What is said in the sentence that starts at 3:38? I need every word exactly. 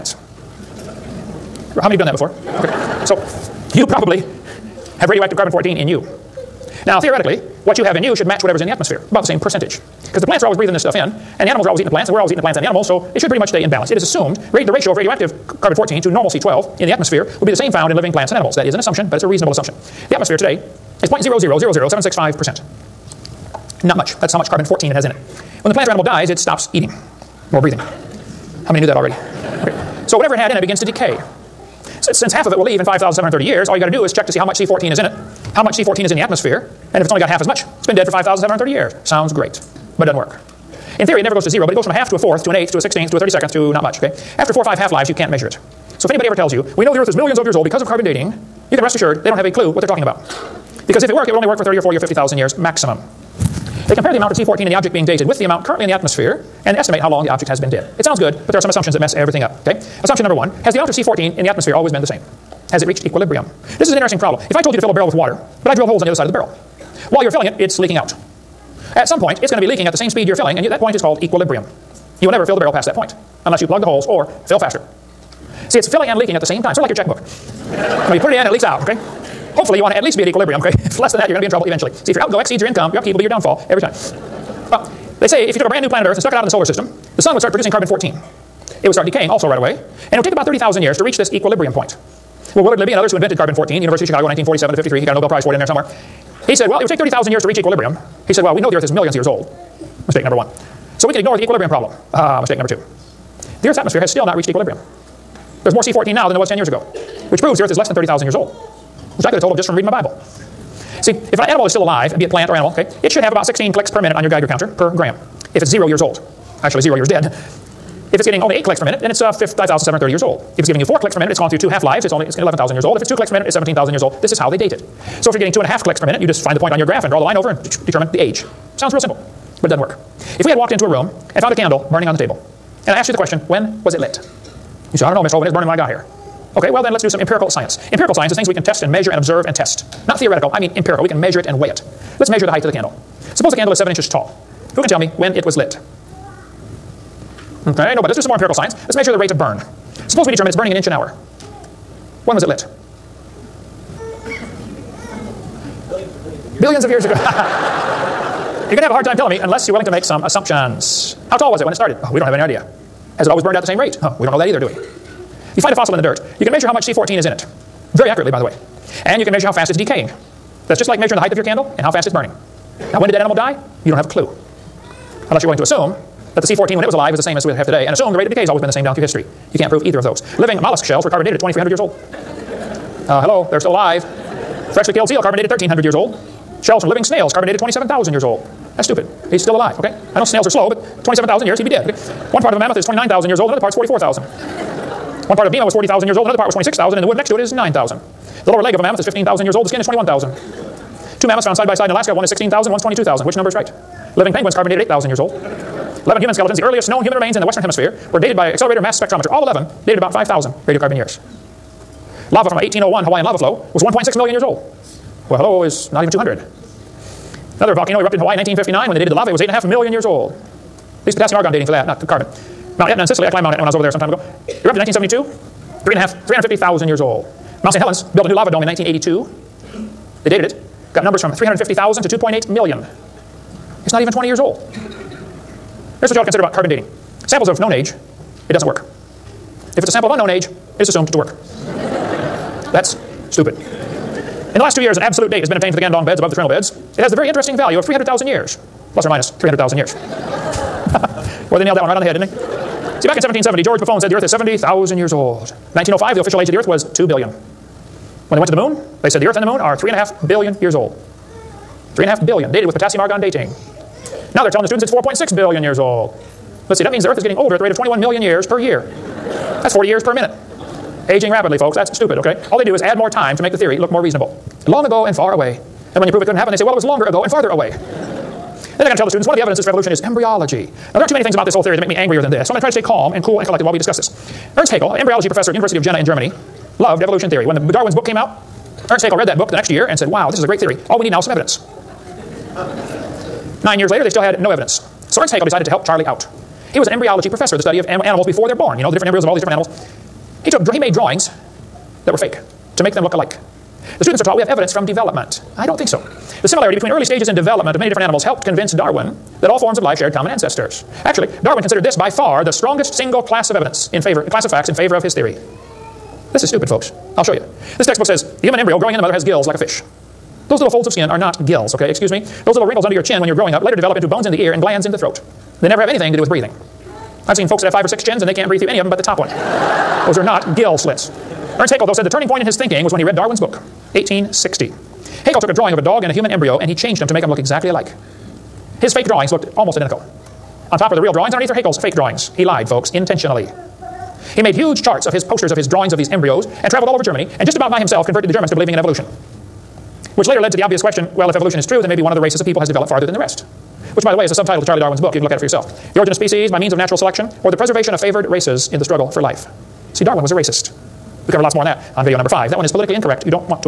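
When they dated the lava, it was 8.5 million years old.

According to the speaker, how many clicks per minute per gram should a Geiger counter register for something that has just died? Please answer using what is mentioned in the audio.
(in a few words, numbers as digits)
16.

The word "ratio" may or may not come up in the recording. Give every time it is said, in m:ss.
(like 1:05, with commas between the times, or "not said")
0:14.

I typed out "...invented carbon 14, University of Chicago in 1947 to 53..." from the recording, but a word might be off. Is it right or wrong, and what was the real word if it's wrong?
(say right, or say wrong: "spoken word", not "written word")
right.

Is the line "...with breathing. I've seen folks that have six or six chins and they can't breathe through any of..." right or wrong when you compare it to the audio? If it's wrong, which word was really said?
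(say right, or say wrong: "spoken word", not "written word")
wrong: "five", not "six".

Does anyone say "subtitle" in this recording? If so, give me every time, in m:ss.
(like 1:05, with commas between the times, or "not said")
5:54.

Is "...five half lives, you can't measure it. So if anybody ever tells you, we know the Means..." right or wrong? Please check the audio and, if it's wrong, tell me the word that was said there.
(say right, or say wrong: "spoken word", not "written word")
wrong: "Earth", not "Means".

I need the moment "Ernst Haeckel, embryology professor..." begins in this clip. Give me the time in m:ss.
4:44.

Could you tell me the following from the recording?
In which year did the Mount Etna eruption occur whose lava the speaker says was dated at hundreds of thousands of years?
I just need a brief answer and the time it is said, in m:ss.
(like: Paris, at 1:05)
1972, at 3:44.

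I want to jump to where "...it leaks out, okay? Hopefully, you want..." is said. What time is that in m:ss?
1:18.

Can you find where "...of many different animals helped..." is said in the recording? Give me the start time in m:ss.
5:07.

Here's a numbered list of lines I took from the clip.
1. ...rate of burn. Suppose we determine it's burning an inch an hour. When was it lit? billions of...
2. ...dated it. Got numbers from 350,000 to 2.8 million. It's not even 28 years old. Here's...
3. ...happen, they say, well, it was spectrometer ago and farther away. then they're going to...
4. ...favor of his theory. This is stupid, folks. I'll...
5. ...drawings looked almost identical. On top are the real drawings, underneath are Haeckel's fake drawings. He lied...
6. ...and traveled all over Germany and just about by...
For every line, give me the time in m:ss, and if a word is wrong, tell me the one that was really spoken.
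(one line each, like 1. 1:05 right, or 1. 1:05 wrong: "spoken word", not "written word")
1. 2:29 right
2. 3:50 wrong: "20", not "28"
3. 4:36 wrong: "longer", not "spectrometer"
4. 5:14 right
5. 5:39 right
6. 5:46 right.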